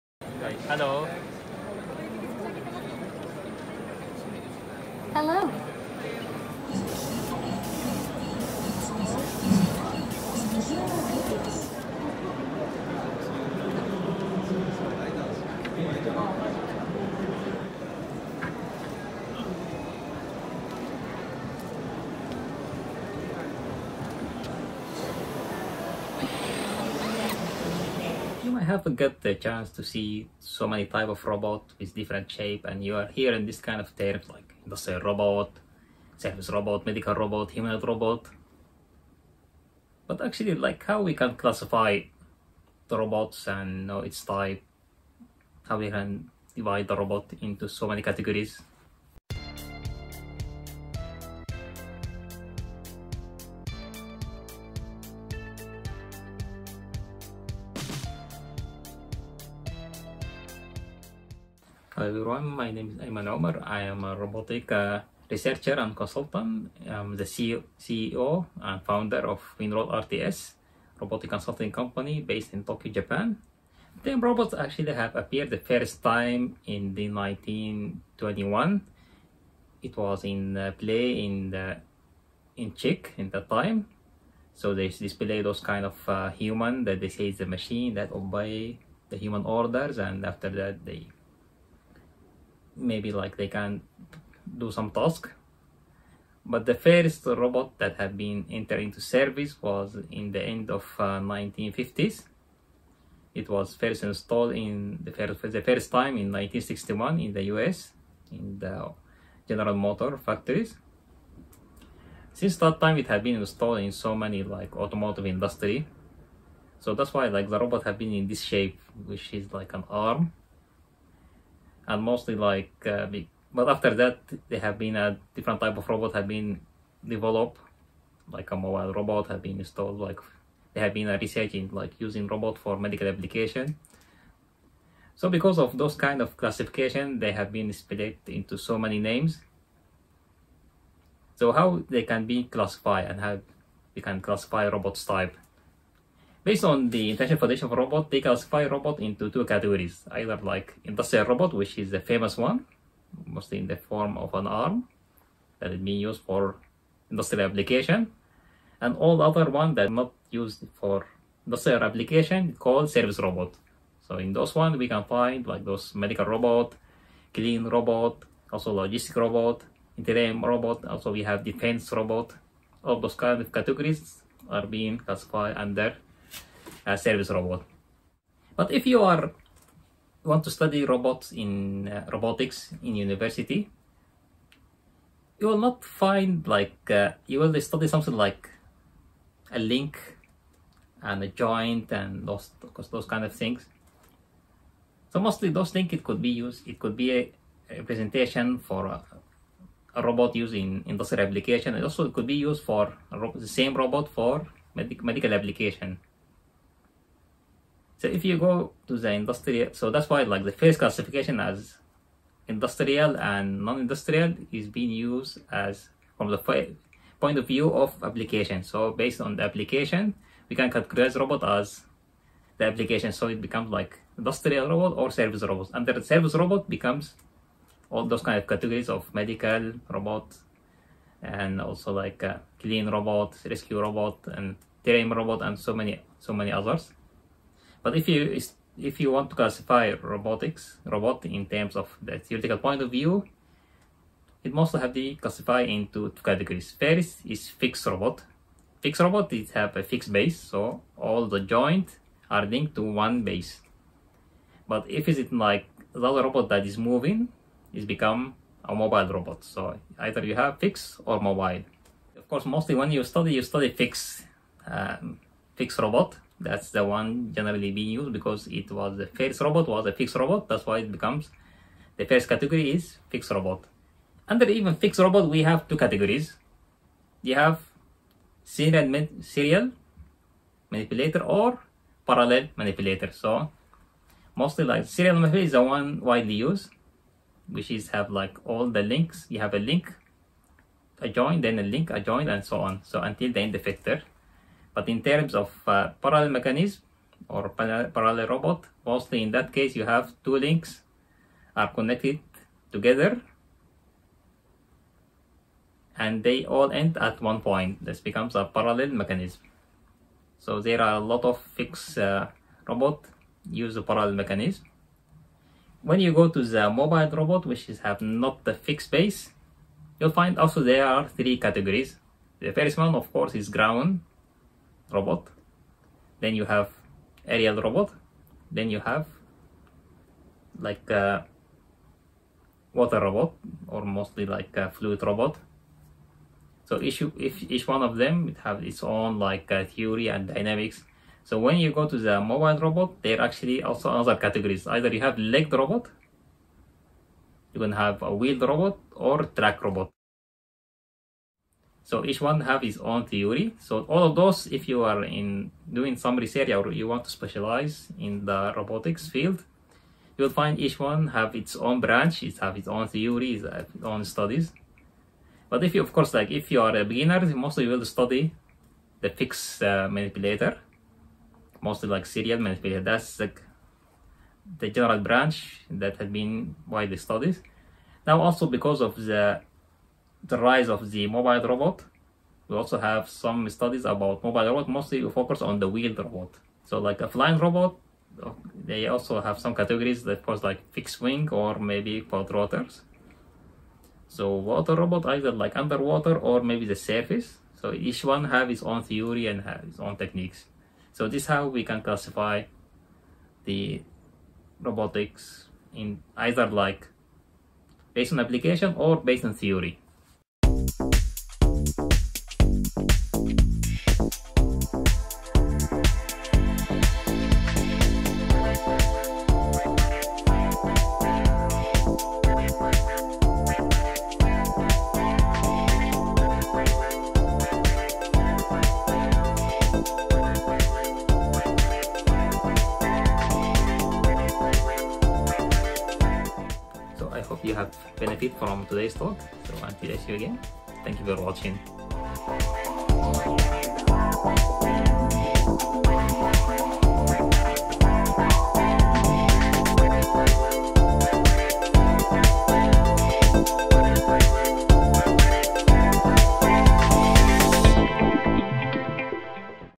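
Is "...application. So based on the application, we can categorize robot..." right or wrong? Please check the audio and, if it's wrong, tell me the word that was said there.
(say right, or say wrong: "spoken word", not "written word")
right.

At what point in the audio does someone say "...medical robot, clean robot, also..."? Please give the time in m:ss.
2:45.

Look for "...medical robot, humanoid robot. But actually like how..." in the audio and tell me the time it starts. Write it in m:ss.
0:36.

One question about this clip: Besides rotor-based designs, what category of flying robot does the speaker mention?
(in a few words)
Fixed wing.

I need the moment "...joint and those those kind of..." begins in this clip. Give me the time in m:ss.
3:11.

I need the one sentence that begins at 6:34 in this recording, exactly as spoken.
So water robot either like underwater or maybe the surface.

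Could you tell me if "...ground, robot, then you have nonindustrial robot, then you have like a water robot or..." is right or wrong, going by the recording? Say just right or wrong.
wrong.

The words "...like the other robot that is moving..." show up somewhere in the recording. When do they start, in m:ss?
4:15.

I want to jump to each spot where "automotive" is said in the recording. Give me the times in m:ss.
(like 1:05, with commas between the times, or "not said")
1:54.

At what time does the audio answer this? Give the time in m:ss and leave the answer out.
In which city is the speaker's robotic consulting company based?
1:12.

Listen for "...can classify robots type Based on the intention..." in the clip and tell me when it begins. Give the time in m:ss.
2:24.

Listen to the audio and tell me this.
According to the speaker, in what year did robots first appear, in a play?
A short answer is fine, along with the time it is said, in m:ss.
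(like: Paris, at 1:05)
1921, at 1:17.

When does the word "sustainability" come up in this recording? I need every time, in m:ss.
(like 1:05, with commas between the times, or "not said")
not said.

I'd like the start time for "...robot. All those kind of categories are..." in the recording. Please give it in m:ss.
2:51.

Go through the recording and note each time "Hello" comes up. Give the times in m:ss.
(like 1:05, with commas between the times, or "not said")
0:00, 0:05, 1:01.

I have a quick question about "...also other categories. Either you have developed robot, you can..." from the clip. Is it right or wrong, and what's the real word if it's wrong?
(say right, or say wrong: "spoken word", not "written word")
wrong: "legged", not "developed".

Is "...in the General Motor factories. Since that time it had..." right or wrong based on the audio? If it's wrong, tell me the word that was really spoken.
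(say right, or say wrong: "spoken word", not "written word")
right.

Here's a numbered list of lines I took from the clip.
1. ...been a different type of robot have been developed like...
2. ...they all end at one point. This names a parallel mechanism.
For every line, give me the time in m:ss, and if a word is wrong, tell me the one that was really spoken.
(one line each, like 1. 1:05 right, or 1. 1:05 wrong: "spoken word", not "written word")
1. 2:04 right
2. 5:06 wrong: "becomes", not "names".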